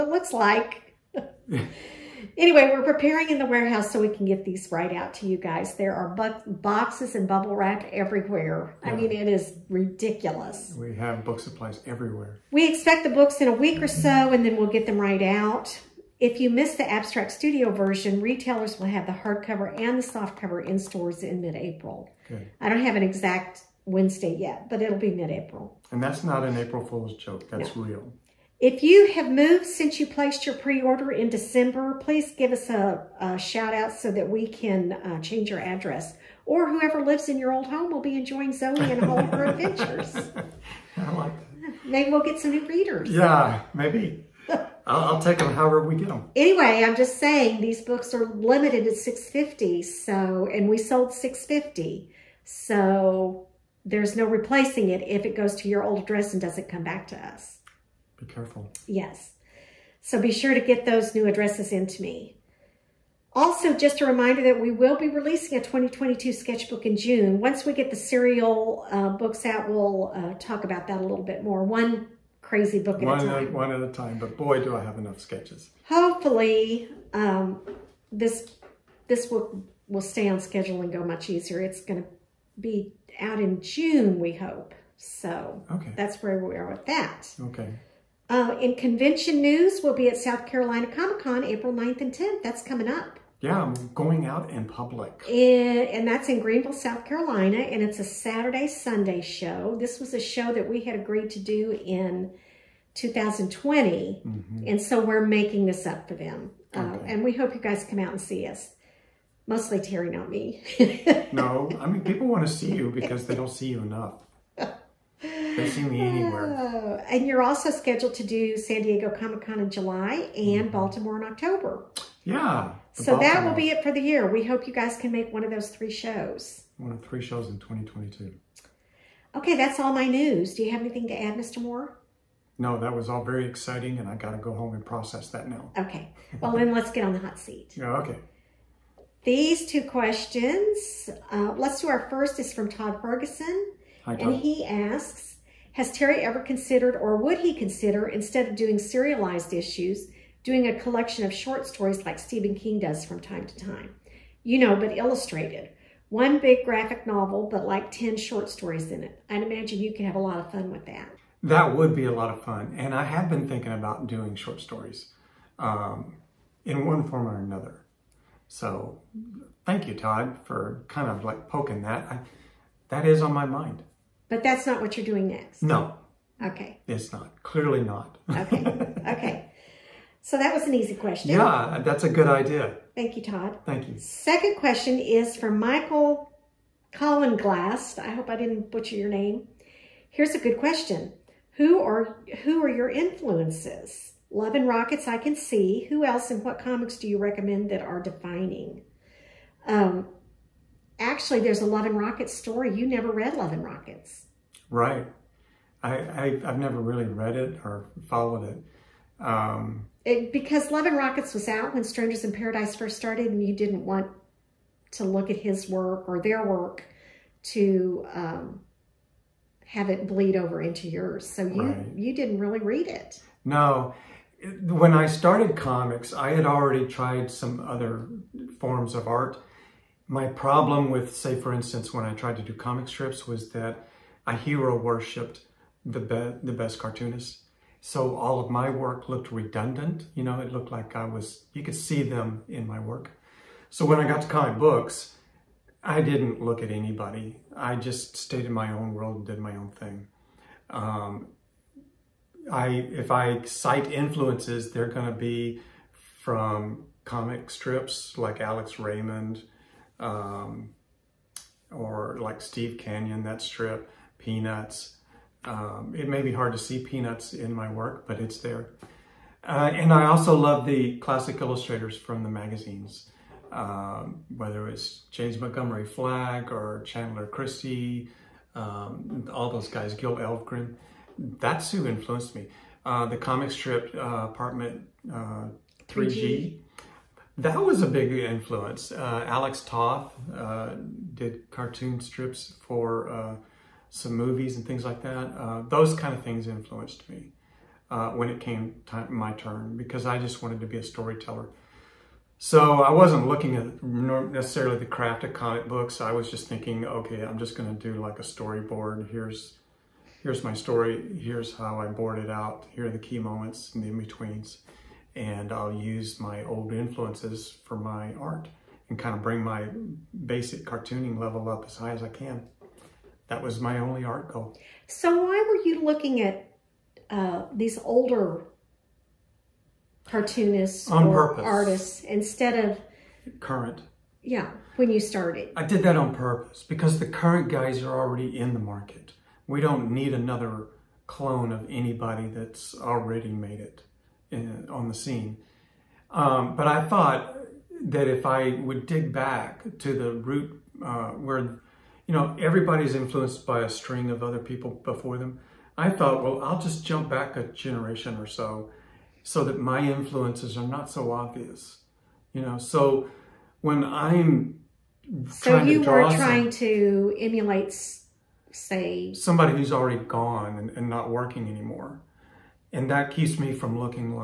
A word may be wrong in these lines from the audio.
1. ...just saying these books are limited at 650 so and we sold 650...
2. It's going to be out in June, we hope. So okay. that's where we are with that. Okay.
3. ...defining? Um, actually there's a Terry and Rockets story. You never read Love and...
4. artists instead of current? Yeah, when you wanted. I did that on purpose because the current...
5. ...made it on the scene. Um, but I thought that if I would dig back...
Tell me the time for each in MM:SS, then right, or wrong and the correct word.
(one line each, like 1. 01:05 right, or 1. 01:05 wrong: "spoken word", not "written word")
1. 00:46 right
2. 01:21 right
3. 03:18 wrong: "Love", not "Terry"
4. 05:31 wrong: "started", not "wanted"
5. 05:43 right.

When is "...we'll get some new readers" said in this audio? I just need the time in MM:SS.
00:42.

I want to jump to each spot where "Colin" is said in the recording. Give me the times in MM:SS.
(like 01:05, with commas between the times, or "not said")
03:06.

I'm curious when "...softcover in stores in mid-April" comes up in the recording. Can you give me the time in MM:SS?
00:20.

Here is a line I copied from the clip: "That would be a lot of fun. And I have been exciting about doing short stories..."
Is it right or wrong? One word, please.
wrong.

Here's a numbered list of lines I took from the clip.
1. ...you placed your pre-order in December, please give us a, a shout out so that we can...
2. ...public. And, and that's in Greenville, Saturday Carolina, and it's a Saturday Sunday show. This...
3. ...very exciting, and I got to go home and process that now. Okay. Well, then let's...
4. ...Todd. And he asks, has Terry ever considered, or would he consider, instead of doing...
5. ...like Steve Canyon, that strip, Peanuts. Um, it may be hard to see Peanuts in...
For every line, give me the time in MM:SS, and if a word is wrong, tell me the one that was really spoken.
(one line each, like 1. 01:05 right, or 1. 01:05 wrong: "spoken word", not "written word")
1. 00:29 right
2. 01:34 wrong: "South", not "Saturday"
3. 02:13 right
4. 02:24 right
5. 04:22 right.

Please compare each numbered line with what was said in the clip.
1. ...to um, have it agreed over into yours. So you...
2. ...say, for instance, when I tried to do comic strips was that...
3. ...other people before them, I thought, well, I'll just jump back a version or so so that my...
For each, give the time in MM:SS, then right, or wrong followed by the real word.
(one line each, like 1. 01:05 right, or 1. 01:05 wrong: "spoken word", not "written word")
1. 03:37 wrong: "bleed", not "agreed"
2. 03:51 right
3. 05:54 wrong: "generation", not "version".